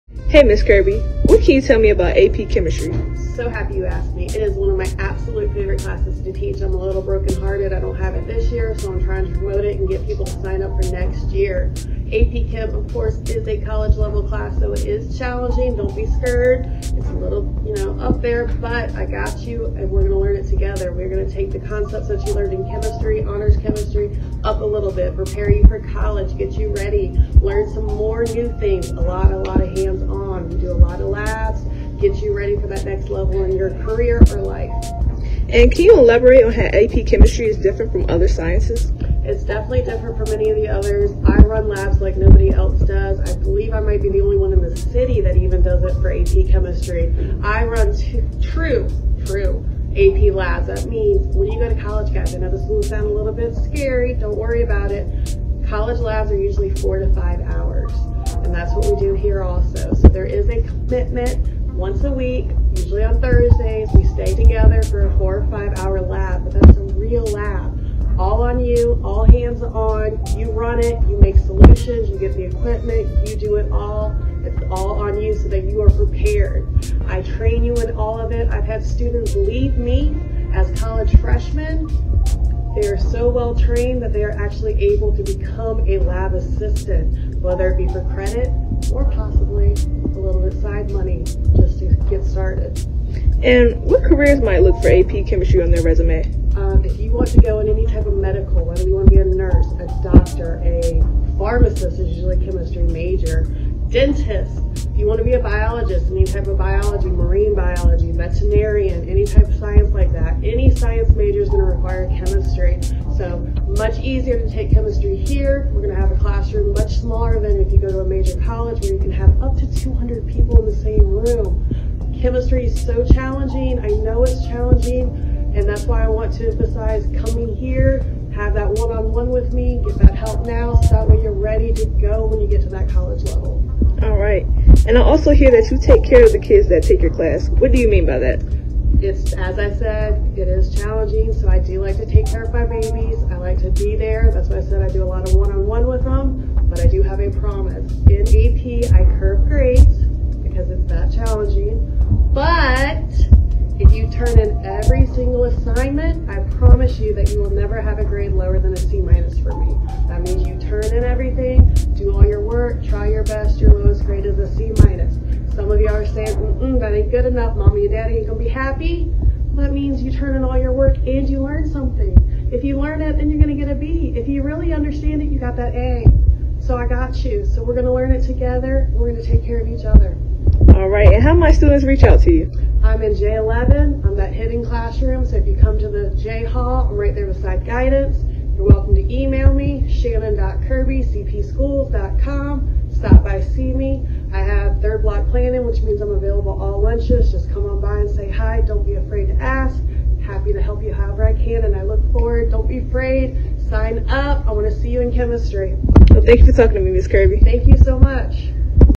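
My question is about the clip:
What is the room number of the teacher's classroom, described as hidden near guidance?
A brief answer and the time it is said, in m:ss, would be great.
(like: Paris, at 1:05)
J11, at 3:03.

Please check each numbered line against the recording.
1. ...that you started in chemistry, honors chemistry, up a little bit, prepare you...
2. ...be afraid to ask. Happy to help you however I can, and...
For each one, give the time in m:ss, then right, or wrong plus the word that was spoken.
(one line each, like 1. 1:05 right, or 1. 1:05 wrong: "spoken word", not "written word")
1. 0:22 wrong: "learned", not "started"
2. 3:18 right.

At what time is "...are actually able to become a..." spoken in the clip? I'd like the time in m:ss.
1:24.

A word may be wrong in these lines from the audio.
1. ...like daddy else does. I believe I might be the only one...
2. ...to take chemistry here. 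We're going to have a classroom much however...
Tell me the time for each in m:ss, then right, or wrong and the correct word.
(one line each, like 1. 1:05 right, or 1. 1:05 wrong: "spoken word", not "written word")
1. 0:42 wrong: "nobody", not "daddy"
2. 1:54 wrong: "smaller", not "however".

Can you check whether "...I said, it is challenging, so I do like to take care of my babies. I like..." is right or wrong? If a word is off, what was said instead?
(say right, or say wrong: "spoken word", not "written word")
right.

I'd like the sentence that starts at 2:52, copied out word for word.
If you learn it, then you're gonna get a B.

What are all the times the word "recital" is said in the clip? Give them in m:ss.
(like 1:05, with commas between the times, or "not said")
not said.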